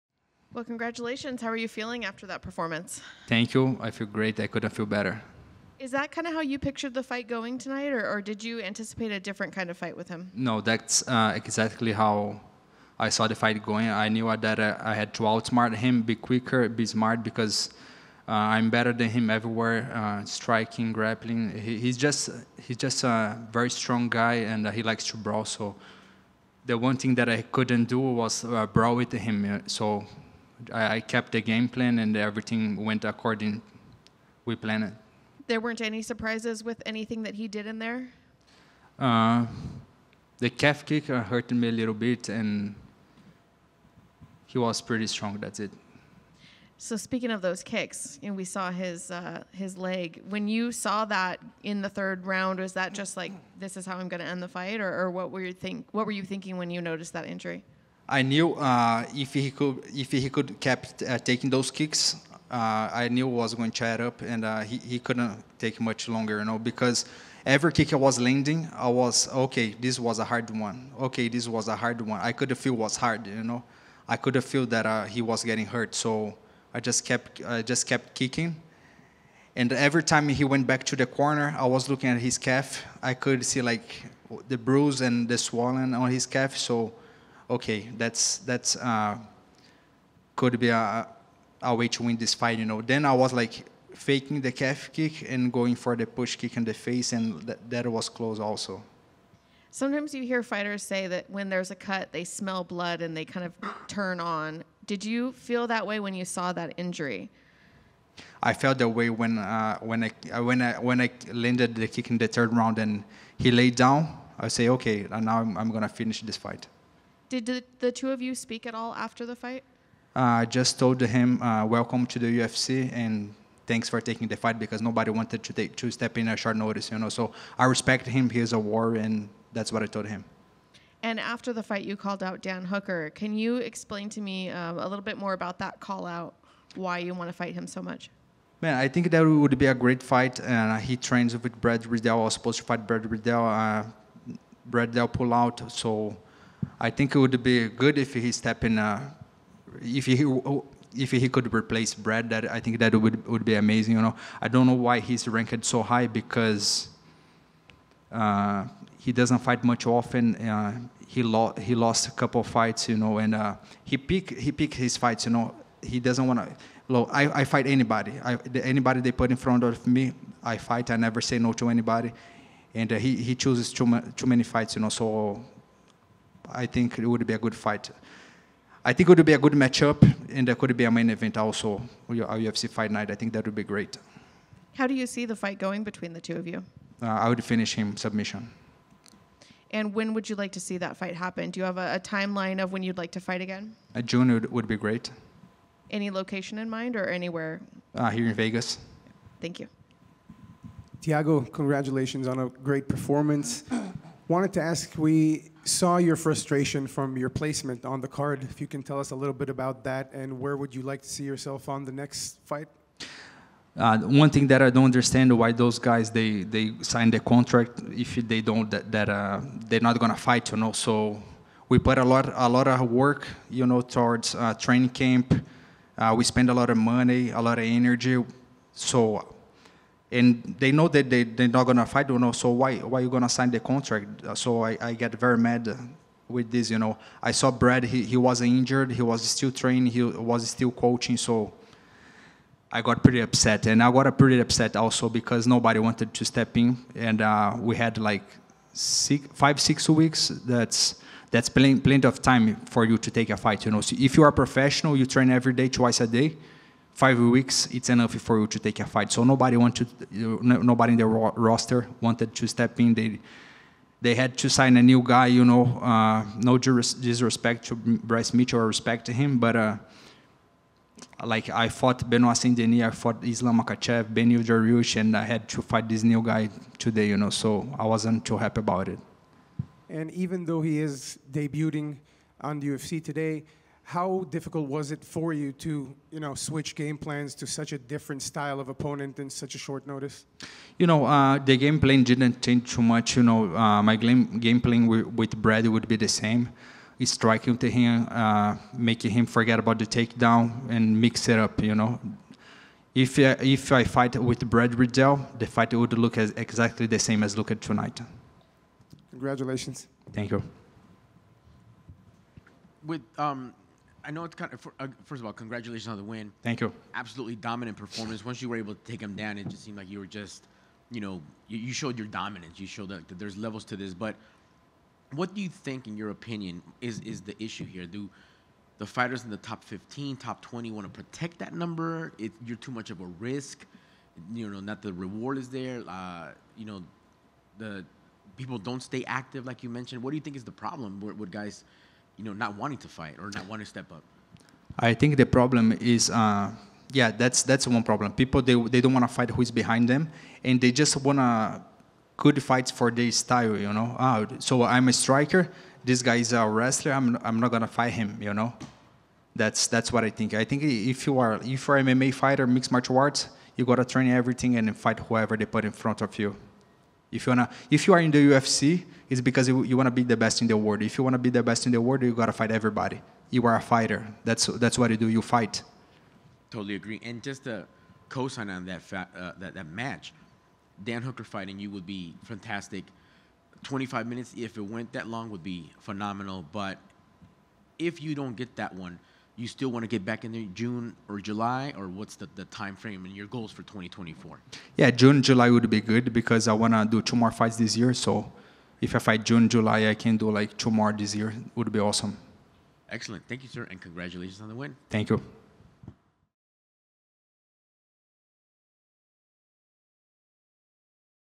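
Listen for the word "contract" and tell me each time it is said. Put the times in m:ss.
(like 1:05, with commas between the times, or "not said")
3:37, 3:53.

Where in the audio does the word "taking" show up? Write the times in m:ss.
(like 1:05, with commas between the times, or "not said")
1:01, 2:04.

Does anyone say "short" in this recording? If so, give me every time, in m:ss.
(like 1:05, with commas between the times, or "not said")
2:06, 4:49.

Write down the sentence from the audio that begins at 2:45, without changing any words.
You know, he doesn't want to.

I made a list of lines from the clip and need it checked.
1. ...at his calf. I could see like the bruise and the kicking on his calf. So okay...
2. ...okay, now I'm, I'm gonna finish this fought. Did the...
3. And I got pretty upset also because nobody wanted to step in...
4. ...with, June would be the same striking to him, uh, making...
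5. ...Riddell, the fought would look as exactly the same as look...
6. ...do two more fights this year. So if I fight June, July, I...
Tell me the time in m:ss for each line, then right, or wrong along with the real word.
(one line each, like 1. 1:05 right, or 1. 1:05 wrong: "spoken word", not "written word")
1. 1:22 wrong: "swelling", not "kicking"
2. 1:54 wrong: "fight", not "fought"
3. 4:03 right
4. 4:54 wrong: "Brad", not "June"
5. 5:04 wrong: "fight", not "fought"
6. 6:36 right.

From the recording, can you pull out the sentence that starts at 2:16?
Why you want to fight him so much?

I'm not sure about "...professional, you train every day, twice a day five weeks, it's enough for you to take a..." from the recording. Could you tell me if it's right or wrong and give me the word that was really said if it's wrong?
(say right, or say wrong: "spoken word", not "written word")
right.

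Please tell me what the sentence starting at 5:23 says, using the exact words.
But what do you think, in your opinion, is is the issue here?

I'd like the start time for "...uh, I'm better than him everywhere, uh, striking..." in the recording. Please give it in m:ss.
0:18.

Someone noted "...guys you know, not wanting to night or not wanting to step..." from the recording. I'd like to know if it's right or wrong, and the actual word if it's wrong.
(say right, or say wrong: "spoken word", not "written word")
wrong: "fight", not "night".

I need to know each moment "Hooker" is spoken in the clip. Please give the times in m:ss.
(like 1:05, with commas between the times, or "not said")
2:12, 6:21.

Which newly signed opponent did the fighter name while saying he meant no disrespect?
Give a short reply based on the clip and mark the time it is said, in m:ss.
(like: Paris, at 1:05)
Bryce Mitchell, at 4:28.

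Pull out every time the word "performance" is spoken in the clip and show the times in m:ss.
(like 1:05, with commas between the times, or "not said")
0:02, 3:22, 5:17.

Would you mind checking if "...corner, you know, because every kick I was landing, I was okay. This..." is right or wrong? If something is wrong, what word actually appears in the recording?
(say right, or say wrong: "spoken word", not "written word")
wrong: "longer", not "corner".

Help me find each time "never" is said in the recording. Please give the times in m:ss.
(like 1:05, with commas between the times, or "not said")
2:50.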